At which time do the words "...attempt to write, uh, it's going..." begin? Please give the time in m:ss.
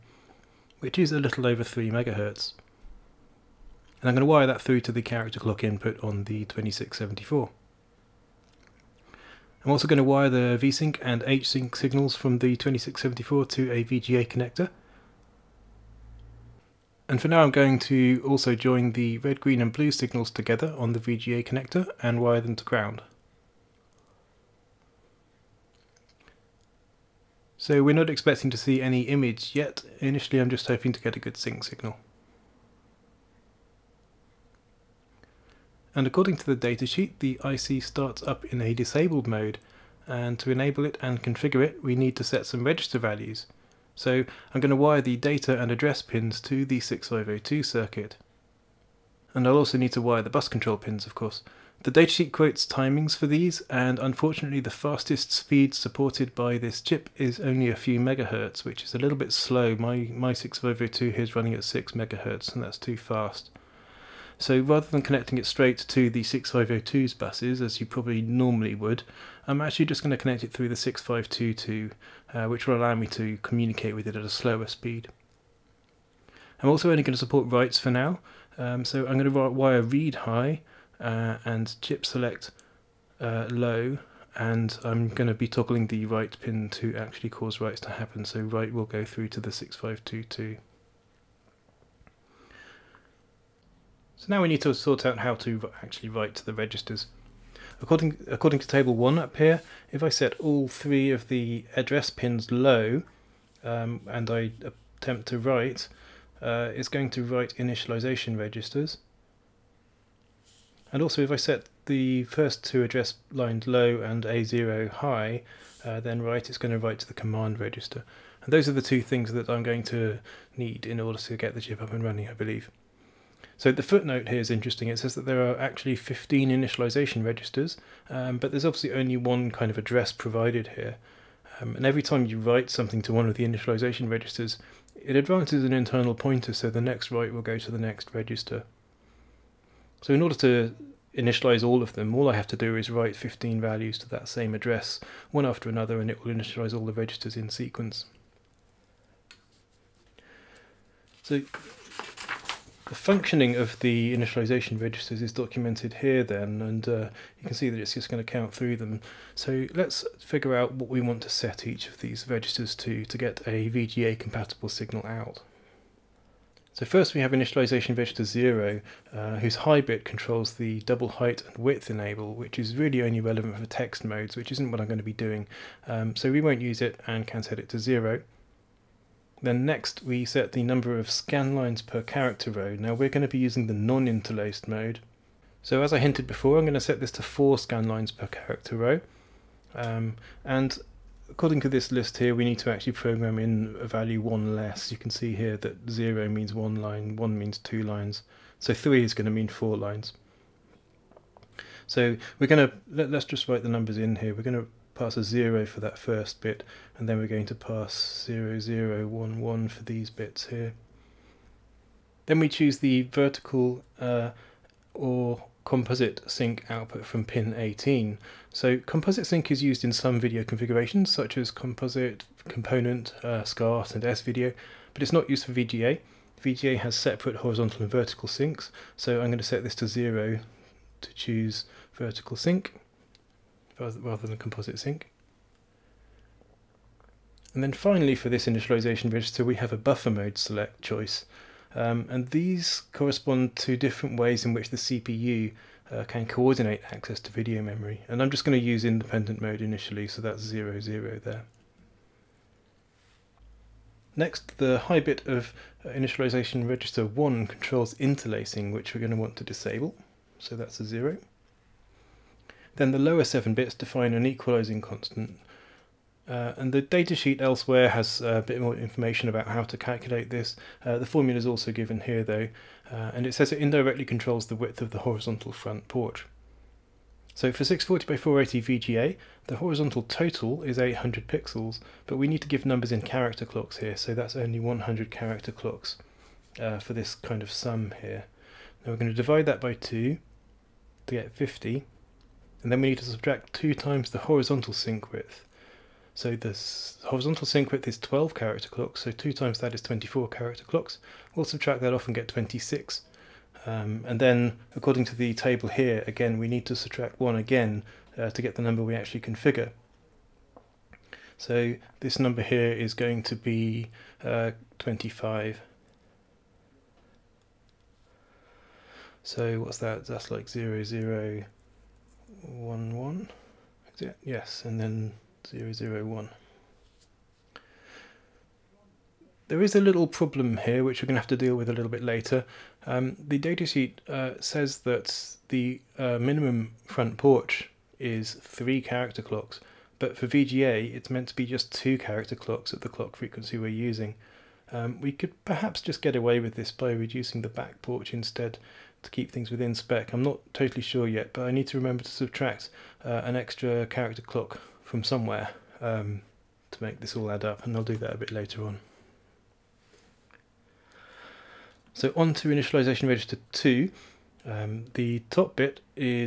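1:45.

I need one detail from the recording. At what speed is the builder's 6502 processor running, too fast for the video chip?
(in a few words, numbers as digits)
6 megahertz.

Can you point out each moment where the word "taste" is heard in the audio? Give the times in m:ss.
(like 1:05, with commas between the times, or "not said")
not said.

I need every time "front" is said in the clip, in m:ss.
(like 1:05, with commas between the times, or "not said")
4:35, 5:36.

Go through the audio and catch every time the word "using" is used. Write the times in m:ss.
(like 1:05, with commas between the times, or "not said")
3:03, 5:43.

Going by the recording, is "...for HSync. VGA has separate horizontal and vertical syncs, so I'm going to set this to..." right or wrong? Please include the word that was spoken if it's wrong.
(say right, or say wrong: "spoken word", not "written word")
wrong: "VGA", not "HSync".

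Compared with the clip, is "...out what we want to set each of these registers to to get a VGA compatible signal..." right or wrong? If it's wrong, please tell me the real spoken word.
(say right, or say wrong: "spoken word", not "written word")
right.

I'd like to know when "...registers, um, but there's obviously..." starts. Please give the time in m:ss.
2:07.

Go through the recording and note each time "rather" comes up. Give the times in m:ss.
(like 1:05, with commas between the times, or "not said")
1:04, 3:53.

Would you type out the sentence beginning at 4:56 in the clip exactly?
So the horizontal sync width is 12 character clocks, so 2 times that is 24 character clocks.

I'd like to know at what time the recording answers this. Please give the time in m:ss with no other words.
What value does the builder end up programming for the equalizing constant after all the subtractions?
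5:14.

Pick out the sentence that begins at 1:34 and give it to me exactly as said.
So now we need to sort out how to actually write to the registers.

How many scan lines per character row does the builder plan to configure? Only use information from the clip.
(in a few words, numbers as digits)
4.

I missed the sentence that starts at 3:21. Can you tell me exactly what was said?
So we're going to, let, us just write the numbers in here.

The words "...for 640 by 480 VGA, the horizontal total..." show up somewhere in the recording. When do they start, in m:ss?
4:37.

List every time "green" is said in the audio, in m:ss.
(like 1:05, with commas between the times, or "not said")
0:19.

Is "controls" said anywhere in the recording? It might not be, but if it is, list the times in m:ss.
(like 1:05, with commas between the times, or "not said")
0:50, 2:50, 4:17, 4:34.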